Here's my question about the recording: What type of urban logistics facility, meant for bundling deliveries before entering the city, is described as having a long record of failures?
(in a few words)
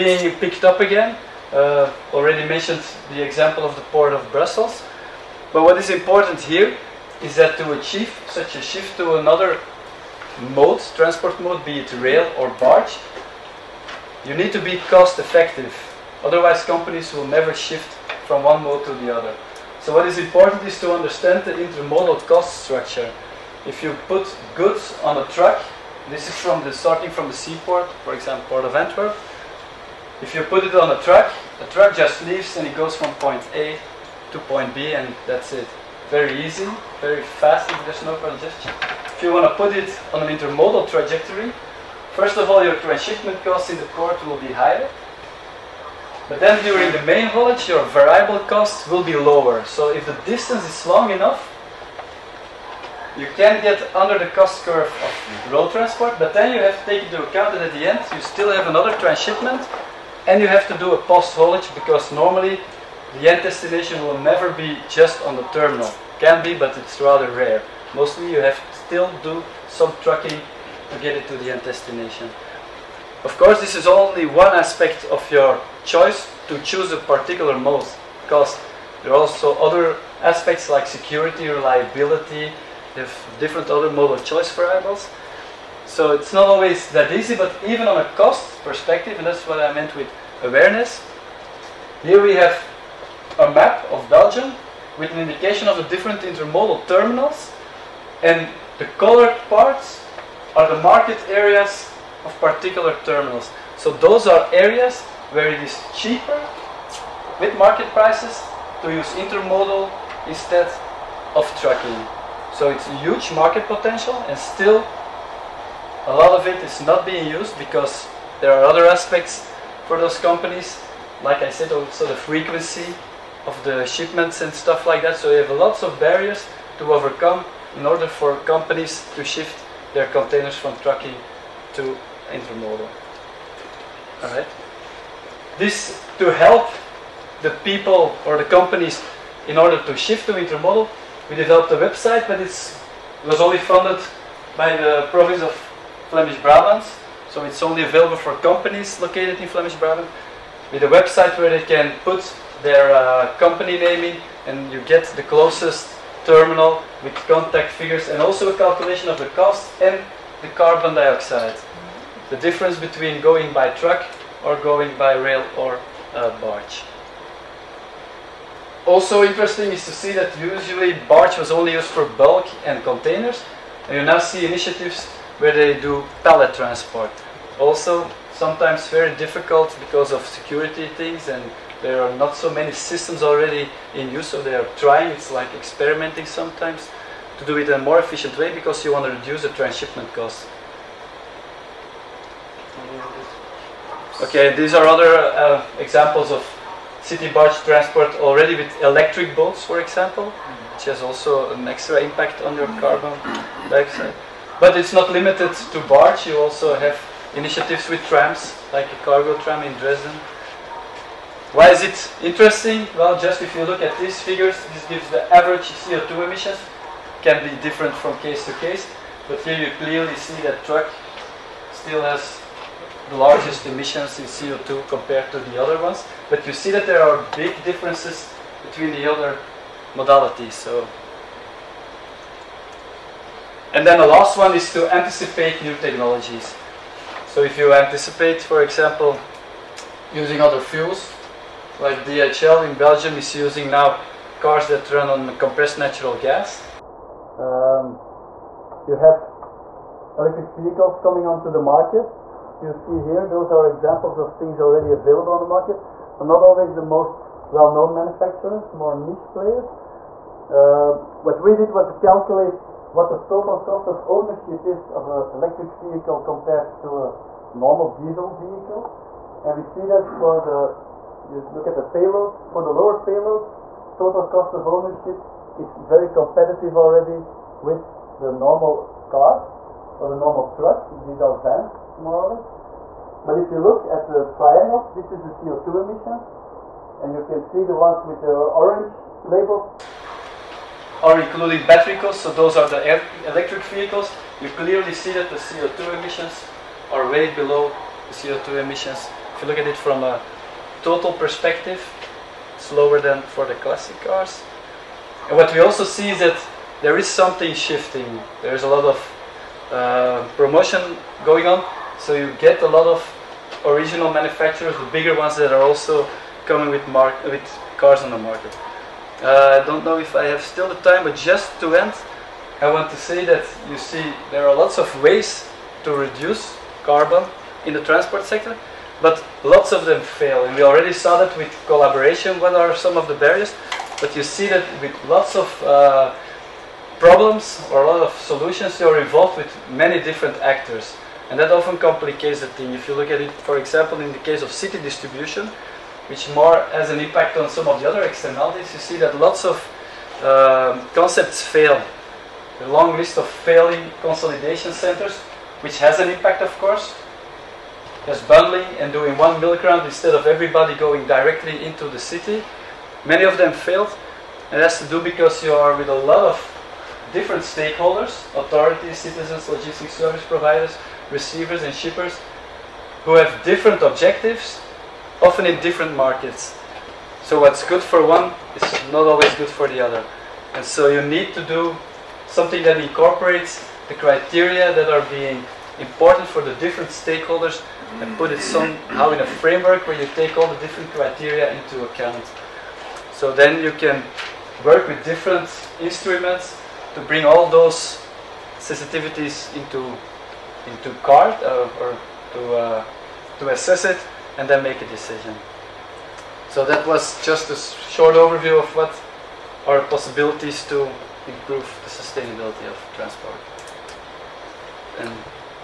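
consolidation centers.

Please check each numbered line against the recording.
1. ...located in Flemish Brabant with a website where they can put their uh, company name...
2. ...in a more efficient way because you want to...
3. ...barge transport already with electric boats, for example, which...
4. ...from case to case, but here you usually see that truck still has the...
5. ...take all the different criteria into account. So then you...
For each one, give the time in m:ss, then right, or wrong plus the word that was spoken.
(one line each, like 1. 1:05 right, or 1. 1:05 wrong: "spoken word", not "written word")
1. 2:28 right
2. 3:07 right
3. 3:17 right
4. 3:37 wrong: "clearly", not "usually"
5. 6:30 right.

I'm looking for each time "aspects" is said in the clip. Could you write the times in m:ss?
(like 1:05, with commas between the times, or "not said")
1:14, 1:20, 1:58.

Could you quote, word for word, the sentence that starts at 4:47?
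And you can see the ones with the orange labels are including battery costs, so those are the electric vehicles.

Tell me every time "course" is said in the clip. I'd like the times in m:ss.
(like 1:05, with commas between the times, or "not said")
1:13, 5:56.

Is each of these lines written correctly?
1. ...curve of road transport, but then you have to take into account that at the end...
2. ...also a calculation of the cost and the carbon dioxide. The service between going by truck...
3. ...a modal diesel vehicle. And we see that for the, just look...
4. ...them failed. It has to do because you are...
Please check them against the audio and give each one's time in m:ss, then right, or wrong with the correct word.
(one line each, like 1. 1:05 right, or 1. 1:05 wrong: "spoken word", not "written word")
1. 0:54 right
2. 2:38 wrong: "difference", not "service"
3. 4:27 wrong: "normal", not "modal"
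4. 6:03 right.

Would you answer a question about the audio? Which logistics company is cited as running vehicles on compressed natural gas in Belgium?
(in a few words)
DHL.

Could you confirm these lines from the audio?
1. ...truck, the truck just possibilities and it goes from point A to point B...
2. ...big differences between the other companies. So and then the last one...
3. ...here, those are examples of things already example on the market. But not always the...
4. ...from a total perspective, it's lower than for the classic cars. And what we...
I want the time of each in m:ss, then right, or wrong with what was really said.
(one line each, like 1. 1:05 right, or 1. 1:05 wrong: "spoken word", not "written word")
1. 0:31 wrong: "leaves", not "possibilities"
2. 3:47 wrong: "modalities", not "companies"
3. 4:12 wrong: "available", not "example"
4. 4:59 right.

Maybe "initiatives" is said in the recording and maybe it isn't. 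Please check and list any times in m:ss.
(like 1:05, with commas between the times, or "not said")
2:54, 3:27.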